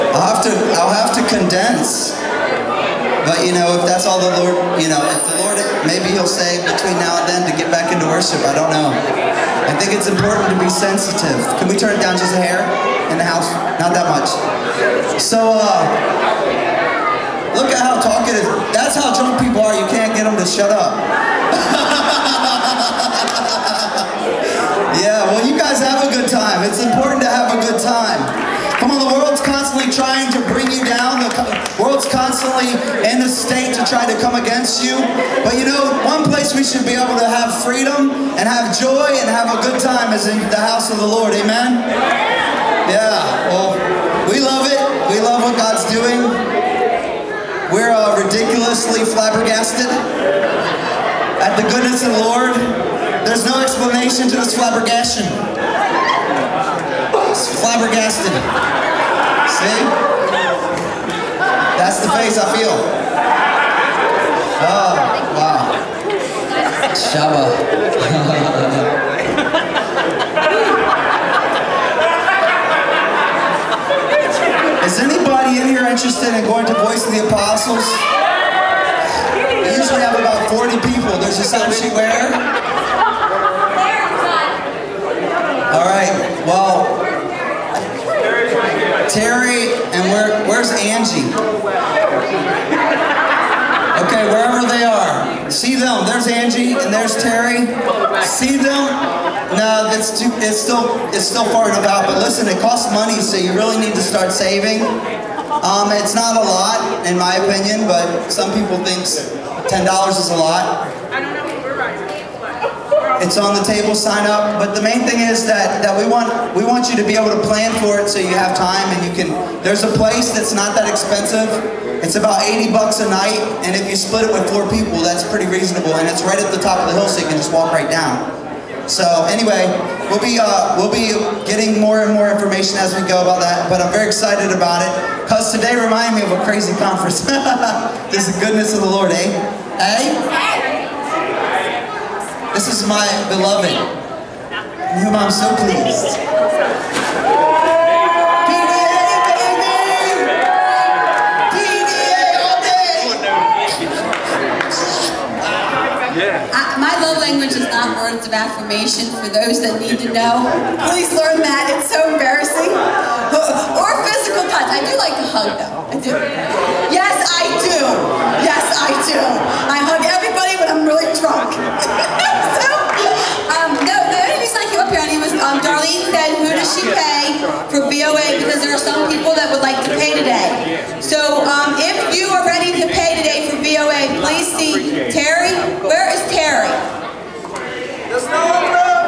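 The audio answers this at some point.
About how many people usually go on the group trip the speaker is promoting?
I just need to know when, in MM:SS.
01:20.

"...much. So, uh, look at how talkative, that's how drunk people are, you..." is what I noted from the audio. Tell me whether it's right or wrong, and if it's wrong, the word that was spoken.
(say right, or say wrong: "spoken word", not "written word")
right.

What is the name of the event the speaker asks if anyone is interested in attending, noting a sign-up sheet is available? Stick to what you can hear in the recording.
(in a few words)
Voice of the Apostles.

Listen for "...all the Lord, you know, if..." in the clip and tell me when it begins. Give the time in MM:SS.
00:04.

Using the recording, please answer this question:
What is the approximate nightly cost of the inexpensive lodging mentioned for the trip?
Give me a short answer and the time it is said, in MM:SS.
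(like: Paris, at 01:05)
$80, at 02:02.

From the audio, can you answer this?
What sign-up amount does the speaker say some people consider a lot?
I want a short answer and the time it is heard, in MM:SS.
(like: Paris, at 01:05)
$10, at 01:49.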